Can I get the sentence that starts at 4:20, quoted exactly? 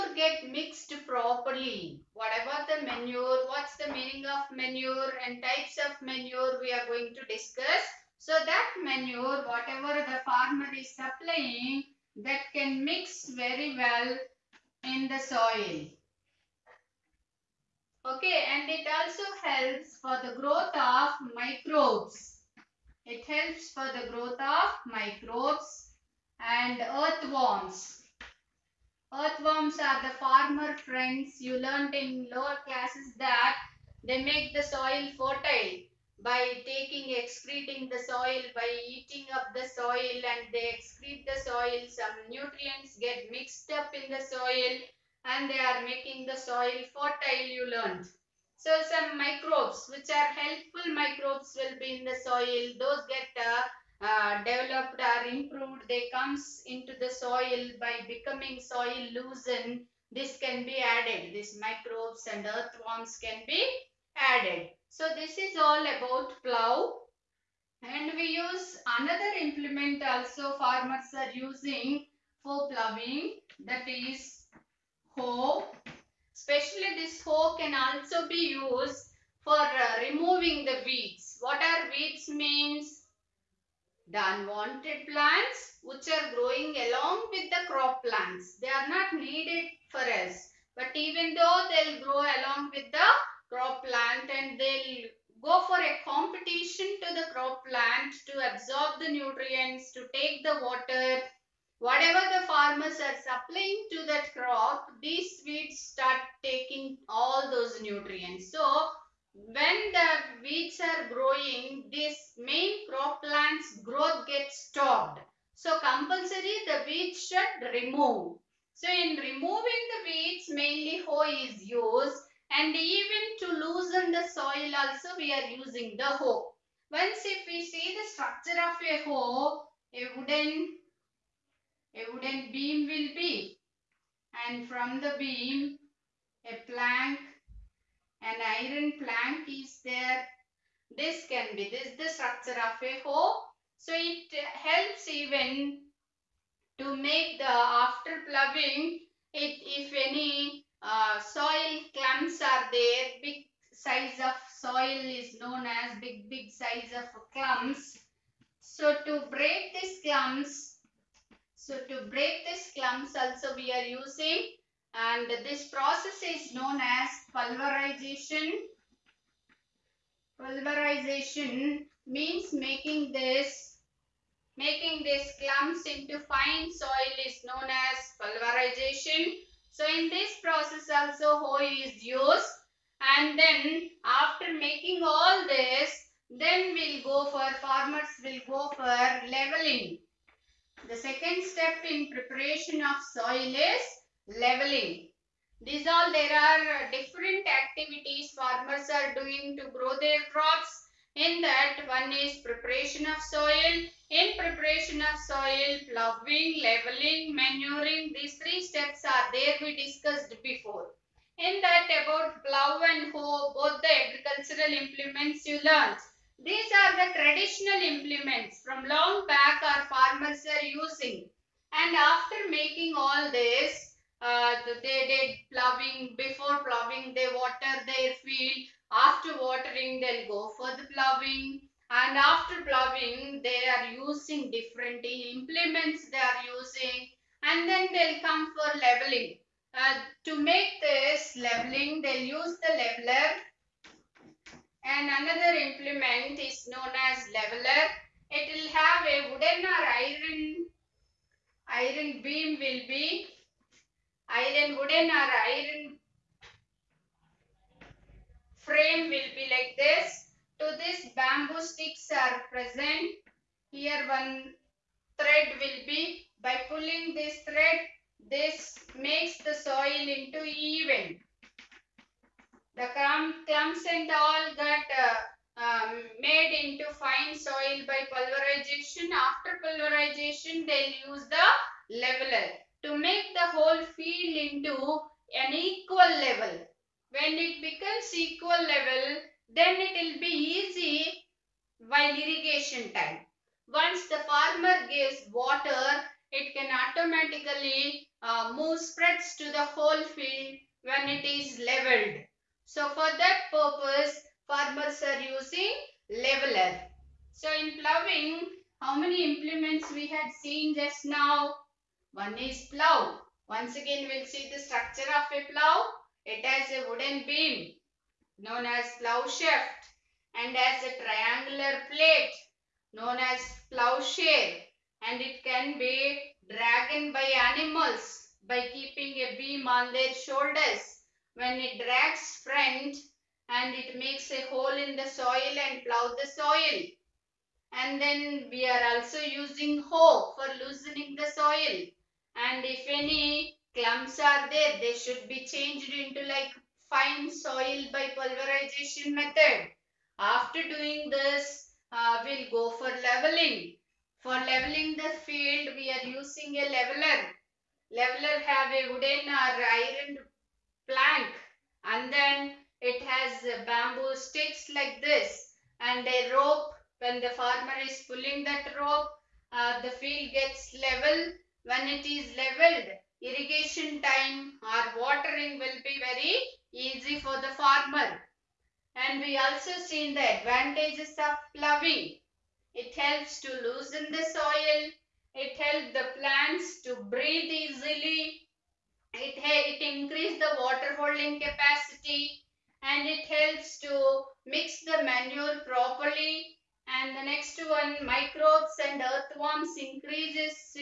To this bamboo sticks are present.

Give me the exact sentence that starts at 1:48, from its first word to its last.
So, when the weeds are growing, this main crop plant's growth gets stopped.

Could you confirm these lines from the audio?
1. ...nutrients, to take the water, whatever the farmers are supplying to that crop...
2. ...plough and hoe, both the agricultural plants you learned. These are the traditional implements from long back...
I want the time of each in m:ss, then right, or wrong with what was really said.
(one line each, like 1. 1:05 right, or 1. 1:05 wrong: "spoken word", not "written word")
1. 1:39 right
2. 3:32 wrong: "implements", not "plants".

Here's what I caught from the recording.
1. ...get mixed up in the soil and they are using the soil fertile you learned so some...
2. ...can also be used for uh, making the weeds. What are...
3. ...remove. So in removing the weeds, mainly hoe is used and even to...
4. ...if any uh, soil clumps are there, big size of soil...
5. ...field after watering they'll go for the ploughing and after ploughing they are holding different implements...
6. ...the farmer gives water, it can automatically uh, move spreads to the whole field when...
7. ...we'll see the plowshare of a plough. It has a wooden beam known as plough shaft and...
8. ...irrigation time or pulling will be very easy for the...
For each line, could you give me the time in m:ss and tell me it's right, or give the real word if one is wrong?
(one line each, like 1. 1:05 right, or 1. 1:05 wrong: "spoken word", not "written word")
1. 0:43 wrong: "making", not "using"
2. 1:17 wrong: "removing", not "making"
3. 1:57 right
4. 2:29 right
5. 3:48 wrong: "using", not "holding"
6. 4:54 right
7. 5:14 wrong: "structure", not "plowshare"
8. 6:13 wrong: "watering", not "pulling".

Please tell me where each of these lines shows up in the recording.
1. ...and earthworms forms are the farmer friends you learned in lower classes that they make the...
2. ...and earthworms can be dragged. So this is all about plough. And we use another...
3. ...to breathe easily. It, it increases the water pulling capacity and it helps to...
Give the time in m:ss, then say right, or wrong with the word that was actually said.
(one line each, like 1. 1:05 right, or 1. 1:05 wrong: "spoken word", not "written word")
1. 0:26 right
2. 1:02 wrong: "added", not "dragged"
3. 6:26 wrong: "holding", not "pulling".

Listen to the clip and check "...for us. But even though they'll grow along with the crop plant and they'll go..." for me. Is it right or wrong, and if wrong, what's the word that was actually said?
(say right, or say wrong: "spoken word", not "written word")
right.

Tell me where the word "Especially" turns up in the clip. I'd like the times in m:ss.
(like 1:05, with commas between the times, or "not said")
1:16.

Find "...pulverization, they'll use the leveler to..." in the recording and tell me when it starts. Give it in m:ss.
4:39.